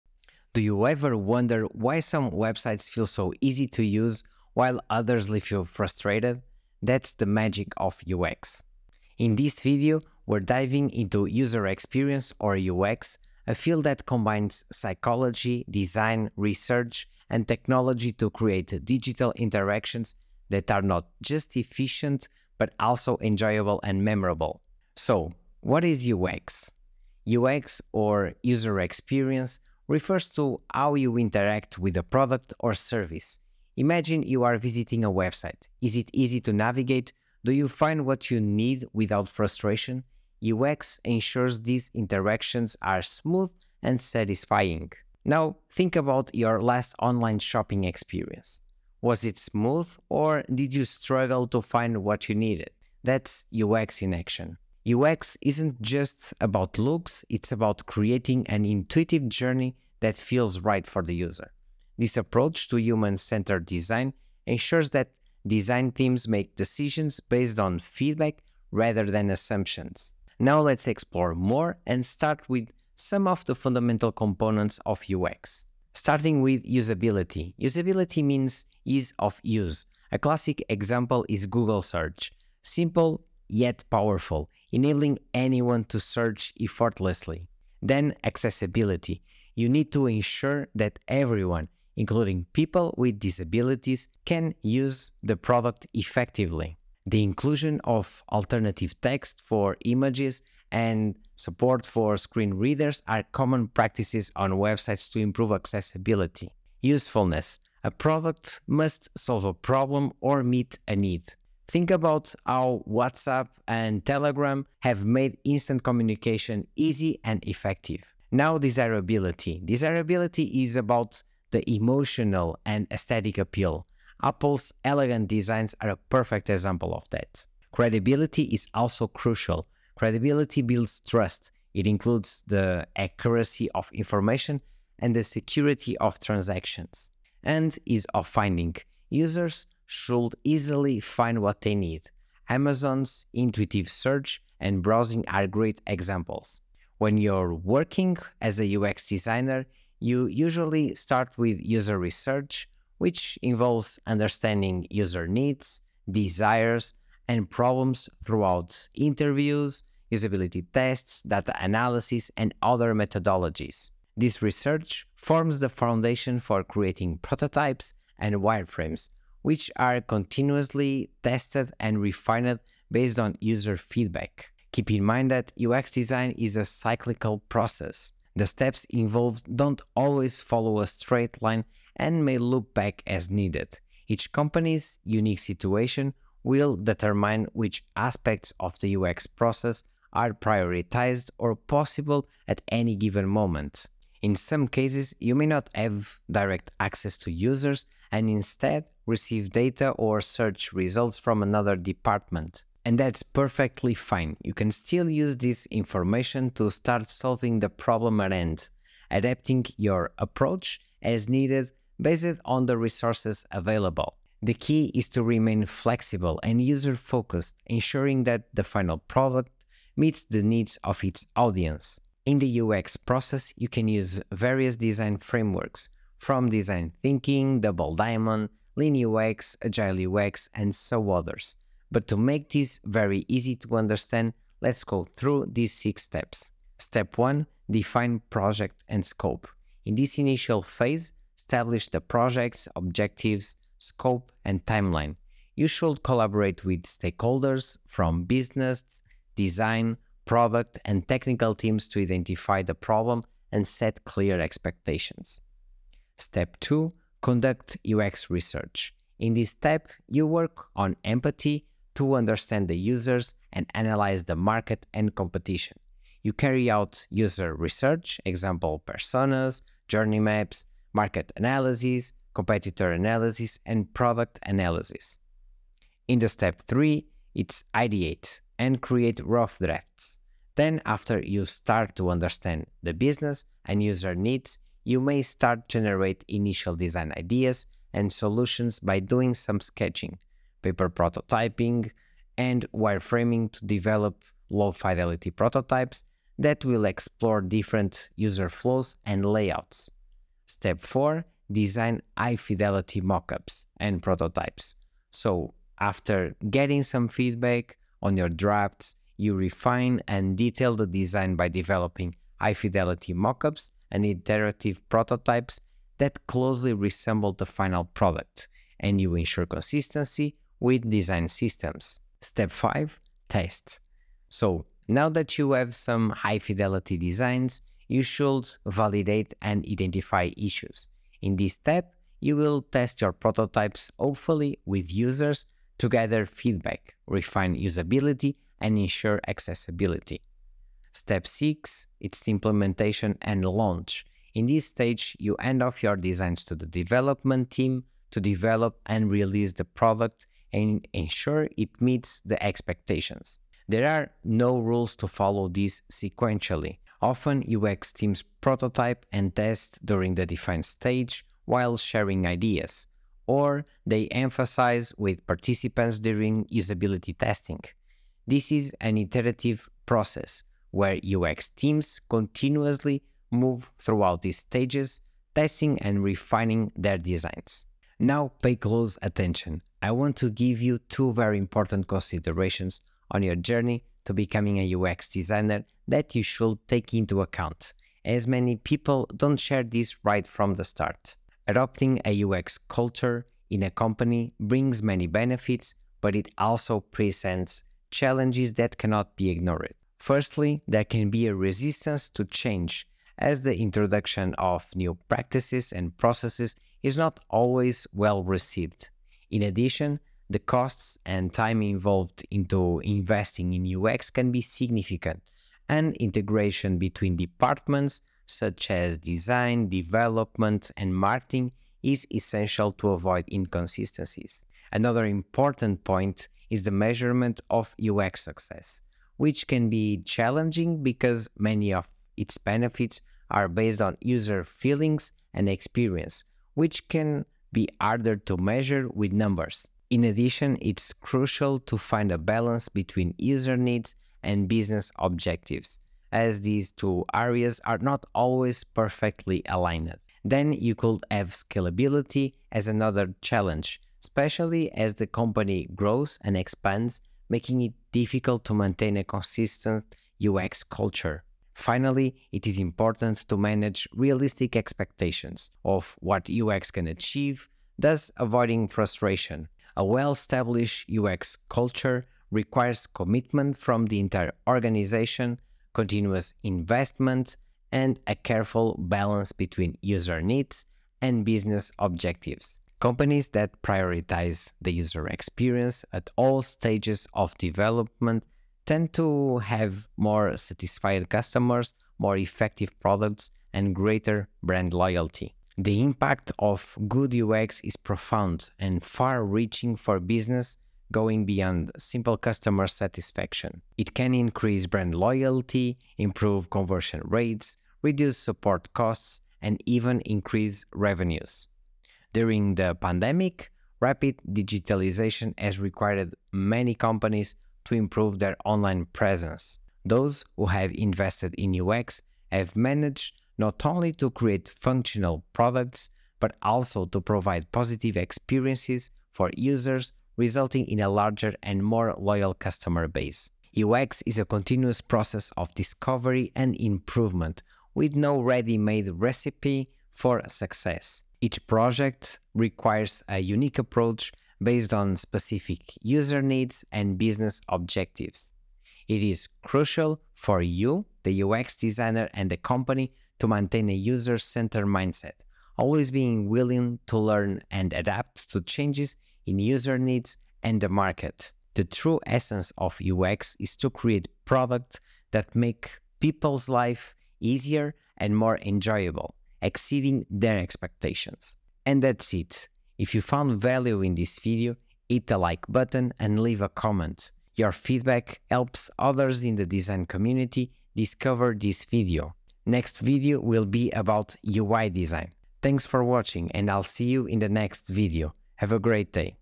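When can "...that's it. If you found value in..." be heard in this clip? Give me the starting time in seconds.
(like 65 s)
571 s.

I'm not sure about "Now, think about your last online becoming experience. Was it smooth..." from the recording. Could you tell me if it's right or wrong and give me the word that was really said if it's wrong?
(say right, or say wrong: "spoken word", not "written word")
wrong: "shopping", not "becoming".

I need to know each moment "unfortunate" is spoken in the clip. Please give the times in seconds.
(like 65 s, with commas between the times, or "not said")
not said.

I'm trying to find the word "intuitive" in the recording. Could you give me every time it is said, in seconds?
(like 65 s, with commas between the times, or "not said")
58 s, 143 s.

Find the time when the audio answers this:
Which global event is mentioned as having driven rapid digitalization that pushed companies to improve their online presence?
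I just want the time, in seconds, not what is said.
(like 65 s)
512 s.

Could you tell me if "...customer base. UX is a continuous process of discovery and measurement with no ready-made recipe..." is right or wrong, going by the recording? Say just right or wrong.
wrong.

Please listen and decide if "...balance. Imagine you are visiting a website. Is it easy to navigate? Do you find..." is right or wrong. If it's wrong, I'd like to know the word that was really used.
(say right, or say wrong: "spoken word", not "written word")
wrong: "service", not "balance".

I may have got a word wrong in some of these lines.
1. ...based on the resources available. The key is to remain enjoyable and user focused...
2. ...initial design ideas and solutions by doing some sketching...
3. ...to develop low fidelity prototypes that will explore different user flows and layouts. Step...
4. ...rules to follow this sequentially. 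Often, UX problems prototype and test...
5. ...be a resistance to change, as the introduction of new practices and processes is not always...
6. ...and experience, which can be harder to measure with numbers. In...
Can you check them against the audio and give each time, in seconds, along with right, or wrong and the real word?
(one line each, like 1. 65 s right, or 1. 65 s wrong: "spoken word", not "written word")
1. 211 s wrong: "flexible", not "enjoyable"
2. 286 s right
3. 293 s right
4. 354 s wrong: "teams", not "problems"
5. 401 s right
6. 435 s right.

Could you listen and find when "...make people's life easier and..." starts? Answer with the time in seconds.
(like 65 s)
565 s.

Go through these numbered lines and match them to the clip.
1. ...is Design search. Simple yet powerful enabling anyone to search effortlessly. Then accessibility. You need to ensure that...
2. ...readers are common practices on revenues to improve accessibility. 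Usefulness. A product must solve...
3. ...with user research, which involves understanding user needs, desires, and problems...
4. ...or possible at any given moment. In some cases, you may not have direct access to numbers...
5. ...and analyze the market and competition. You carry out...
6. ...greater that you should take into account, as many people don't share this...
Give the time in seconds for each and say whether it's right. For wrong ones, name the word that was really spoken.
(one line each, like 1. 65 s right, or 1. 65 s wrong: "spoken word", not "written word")
1. 81 s wrong: "Google", not "Design"
2. 102 s wrong: "websites", not "revenues"
3. 151 s right
4. 191 s wrong: "users", not "numbers"
5. 263 s right
6. 385 s wrong: "designer", not "greater".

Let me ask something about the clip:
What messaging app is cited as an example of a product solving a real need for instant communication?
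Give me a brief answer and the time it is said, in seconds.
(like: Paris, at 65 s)
Telegram, at 114 s.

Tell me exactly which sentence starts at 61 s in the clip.
This approach to human centered design ensures that design teams make decisions based on feedback rather than assumptions.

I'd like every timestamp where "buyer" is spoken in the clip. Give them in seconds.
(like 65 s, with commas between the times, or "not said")
not said.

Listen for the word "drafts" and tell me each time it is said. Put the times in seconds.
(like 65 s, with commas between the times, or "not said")
279 s, 308 s.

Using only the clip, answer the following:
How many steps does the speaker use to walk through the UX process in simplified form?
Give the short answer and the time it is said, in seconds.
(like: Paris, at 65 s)
6, at 235 s.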